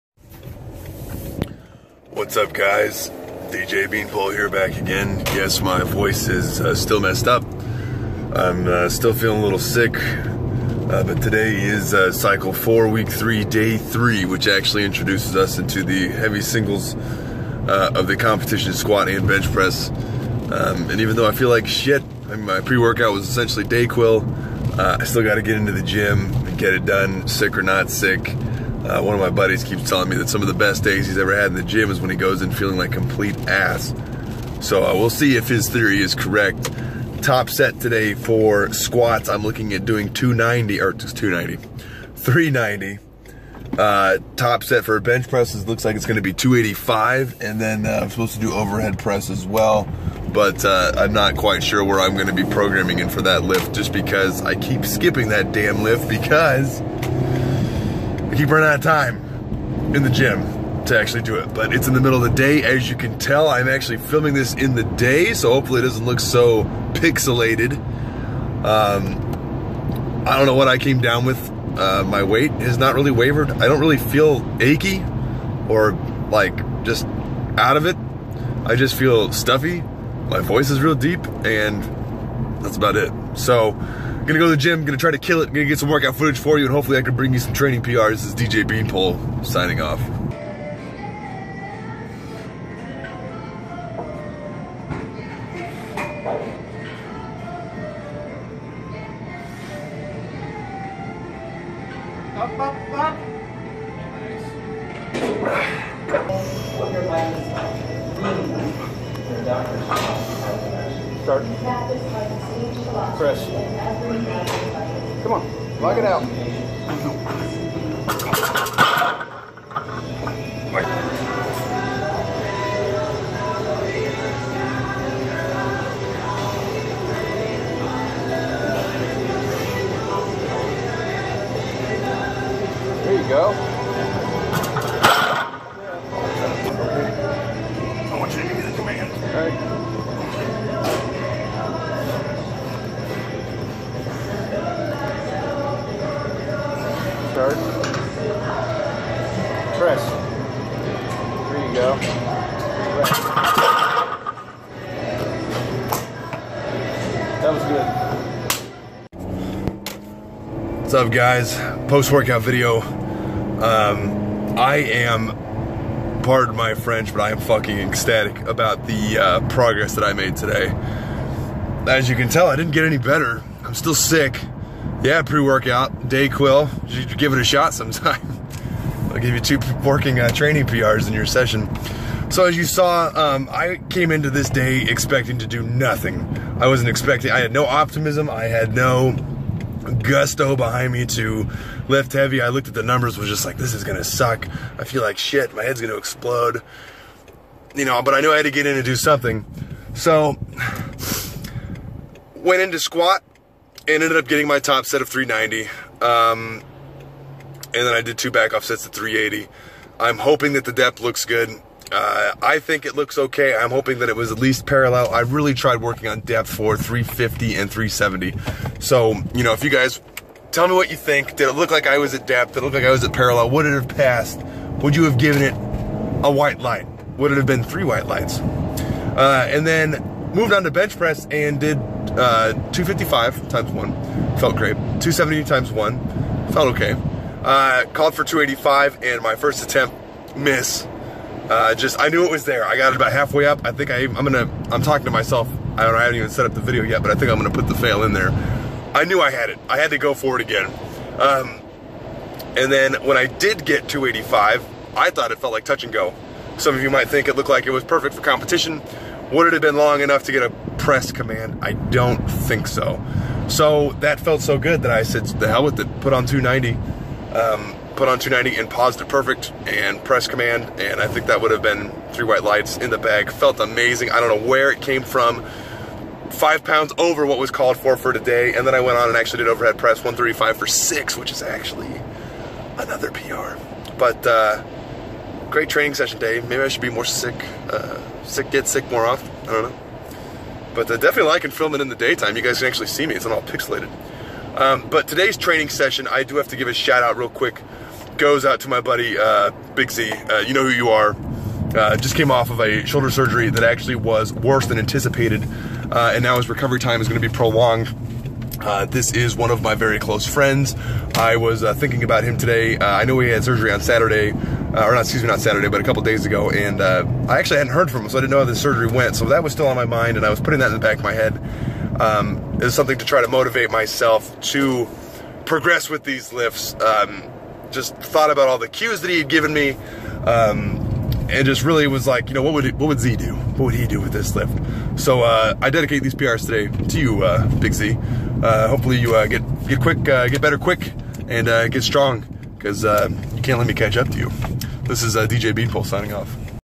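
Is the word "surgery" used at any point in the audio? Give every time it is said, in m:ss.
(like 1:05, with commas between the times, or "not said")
5:03, 5:13, 5:18.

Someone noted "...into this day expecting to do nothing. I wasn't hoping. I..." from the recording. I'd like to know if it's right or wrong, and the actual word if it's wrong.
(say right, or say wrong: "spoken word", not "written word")
wrong: "expecting", not "hoping".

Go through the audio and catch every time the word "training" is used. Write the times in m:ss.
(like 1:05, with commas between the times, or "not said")
1:27, 3:00, 4:45, 4:55.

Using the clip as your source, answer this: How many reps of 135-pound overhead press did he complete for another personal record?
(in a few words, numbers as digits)
6.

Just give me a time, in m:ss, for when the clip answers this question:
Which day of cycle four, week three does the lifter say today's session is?
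0:13.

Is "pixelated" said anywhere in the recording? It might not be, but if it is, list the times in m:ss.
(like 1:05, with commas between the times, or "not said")
1:06, 4:53.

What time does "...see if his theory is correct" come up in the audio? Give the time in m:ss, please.
0:35.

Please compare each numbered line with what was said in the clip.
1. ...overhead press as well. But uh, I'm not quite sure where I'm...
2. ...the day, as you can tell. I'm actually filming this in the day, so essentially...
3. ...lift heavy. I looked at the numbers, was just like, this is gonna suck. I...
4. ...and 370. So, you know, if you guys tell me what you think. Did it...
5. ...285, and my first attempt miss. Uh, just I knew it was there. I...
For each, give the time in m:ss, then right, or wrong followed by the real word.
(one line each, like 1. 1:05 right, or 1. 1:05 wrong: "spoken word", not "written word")
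1. 0:48 right
2. 1:02 wrong: "hopefully", not "essentially"
3. 3:11 right
4. 3:37 right
5. 3:58 right.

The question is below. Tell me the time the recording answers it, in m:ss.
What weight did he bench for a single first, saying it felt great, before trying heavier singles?
3:52.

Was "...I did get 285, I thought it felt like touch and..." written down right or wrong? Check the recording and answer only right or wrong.
right.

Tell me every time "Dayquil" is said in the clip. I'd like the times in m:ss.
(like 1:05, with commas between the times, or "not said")
0:23, 2:56.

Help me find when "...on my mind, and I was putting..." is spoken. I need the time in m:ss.
5:19.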